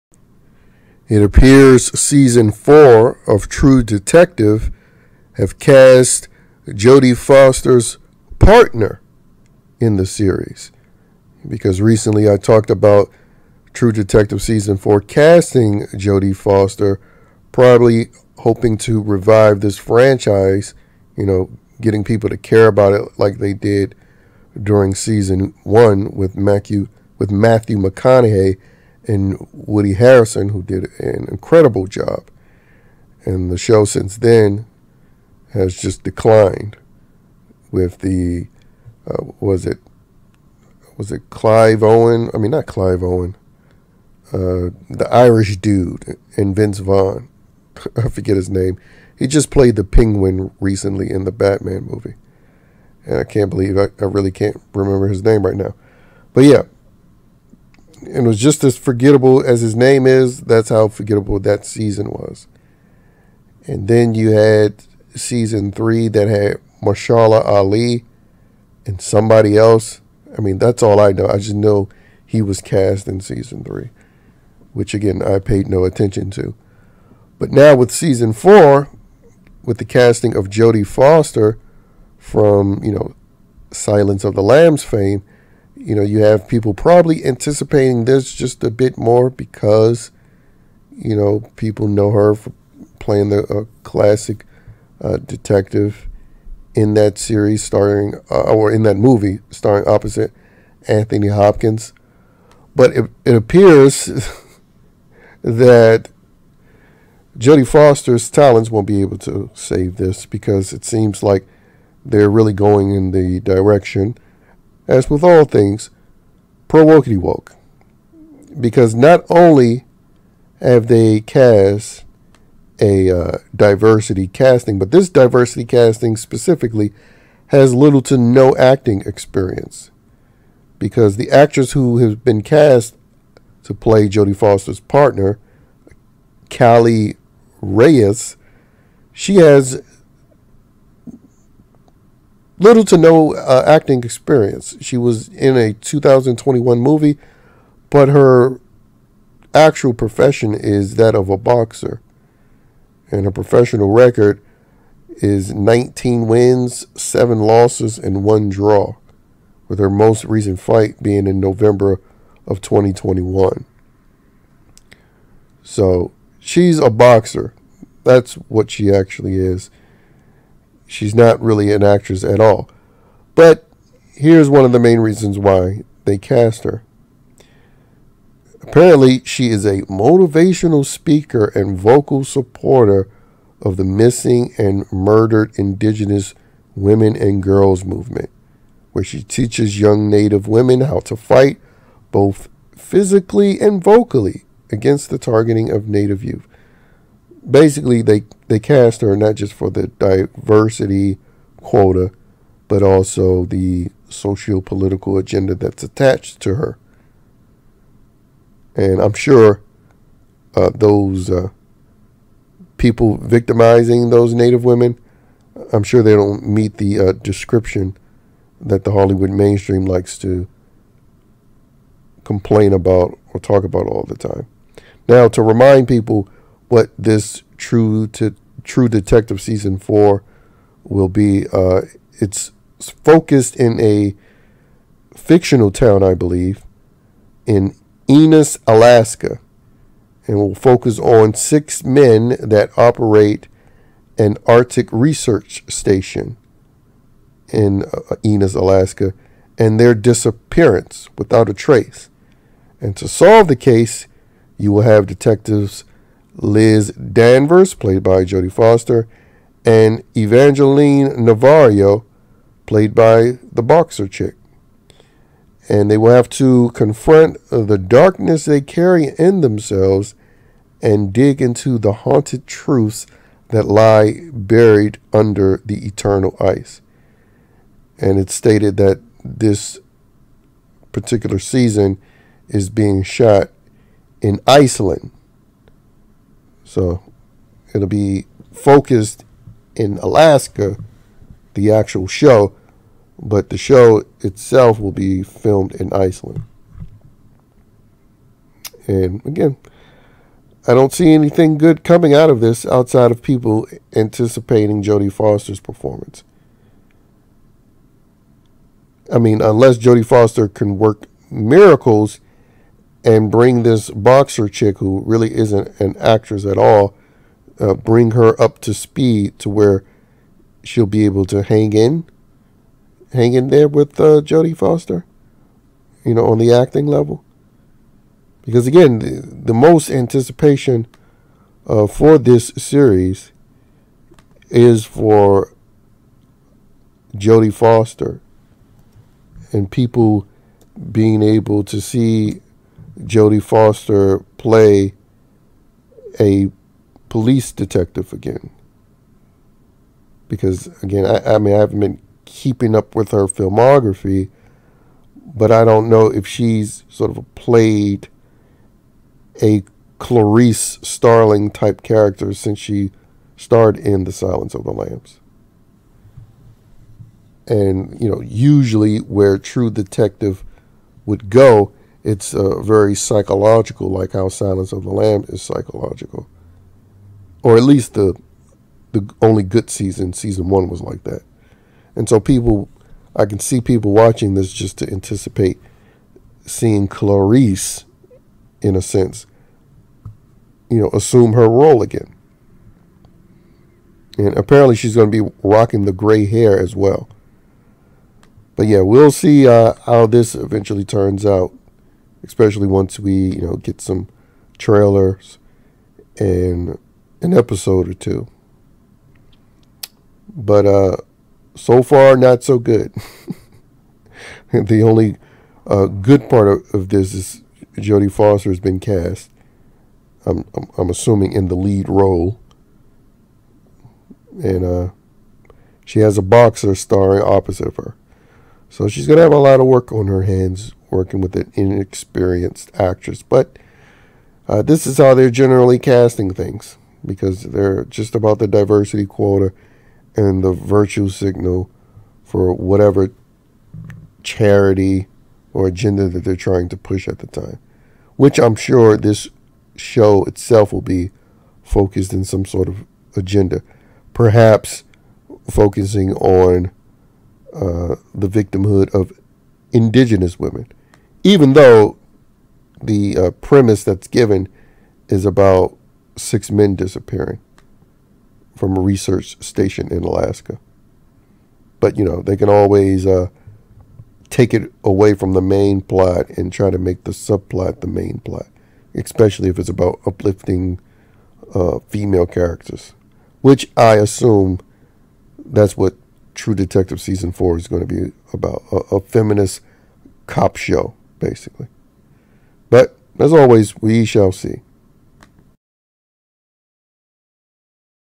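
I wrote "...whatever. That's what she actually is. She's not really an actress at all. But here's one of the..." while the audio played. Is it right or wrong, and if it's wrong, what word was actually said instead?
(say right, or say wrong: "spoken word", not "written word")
wrong: "boxer", not "whatever".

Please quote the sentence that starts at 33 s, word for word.
And the show since then has just declined with the, uh, was it, was it Clive Owen?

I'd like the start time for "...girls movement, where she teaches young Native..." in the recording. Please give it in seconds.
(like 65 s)
187 s.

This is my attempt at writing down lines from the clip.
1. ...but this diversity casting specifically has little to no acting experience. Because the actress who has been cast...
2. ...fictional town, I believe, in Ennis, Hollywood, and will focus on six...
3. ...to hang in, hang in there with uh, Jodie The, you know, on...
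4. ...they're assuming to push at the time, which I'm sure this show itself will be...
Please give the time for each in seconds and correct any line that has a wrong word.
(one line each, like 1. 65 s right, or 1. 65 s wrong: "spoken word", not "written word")
1. 124 s right
2. 235 s wrong: "Alaska", not "Hollywood"
3. 321 s wrong: "Foster", not "The"
4. 446 s wrong: "trying", not "assuming".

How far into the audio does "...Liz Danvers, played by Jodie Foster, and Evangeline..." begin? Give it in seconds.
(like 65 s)
256 s.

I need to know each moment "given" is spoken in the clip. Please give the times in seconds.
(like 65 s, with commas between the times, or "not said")
464 s.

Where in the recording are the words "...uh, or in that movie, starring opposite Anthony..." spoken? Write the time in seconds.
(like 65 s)
98 s.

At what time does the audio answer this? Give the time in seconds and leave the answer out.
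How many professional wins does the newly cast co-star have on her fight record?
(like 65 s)
155 s.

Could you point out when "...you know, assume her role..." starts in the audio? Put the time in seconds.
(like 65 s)
390 s.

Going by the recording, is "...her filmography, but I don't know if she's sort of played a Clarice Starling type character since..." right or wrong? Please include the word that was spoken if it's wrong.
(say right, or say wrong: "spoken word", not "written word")
right.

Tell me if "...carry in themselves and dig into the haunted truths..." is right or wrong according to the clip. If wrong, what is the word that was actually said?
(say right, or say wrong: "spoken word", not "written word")
right.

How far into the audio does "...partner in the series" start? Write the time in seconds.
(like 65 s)
8 s.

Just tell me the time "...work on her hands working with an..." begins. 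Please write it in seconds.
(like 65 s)
429 s.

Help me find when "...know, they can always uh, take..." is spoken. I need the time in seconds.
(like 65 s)
472 s.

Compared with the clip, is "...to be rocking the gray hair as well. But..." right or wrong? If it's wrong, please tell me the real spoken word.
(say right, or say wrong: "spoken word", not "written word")
right.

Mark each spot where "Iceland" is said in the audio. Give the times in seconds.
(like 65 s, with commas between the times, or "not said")
284 s, 295 s.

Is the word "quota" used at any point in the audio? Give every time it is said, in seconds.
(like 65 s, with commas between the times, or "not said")
201 s, 439 s.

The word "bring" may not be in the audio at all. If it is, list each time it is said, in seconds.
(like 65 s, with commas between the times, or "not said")
313 s, 317 s.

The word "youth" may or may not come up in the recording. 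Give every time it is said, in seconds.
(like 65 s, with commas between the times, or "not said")
196 s.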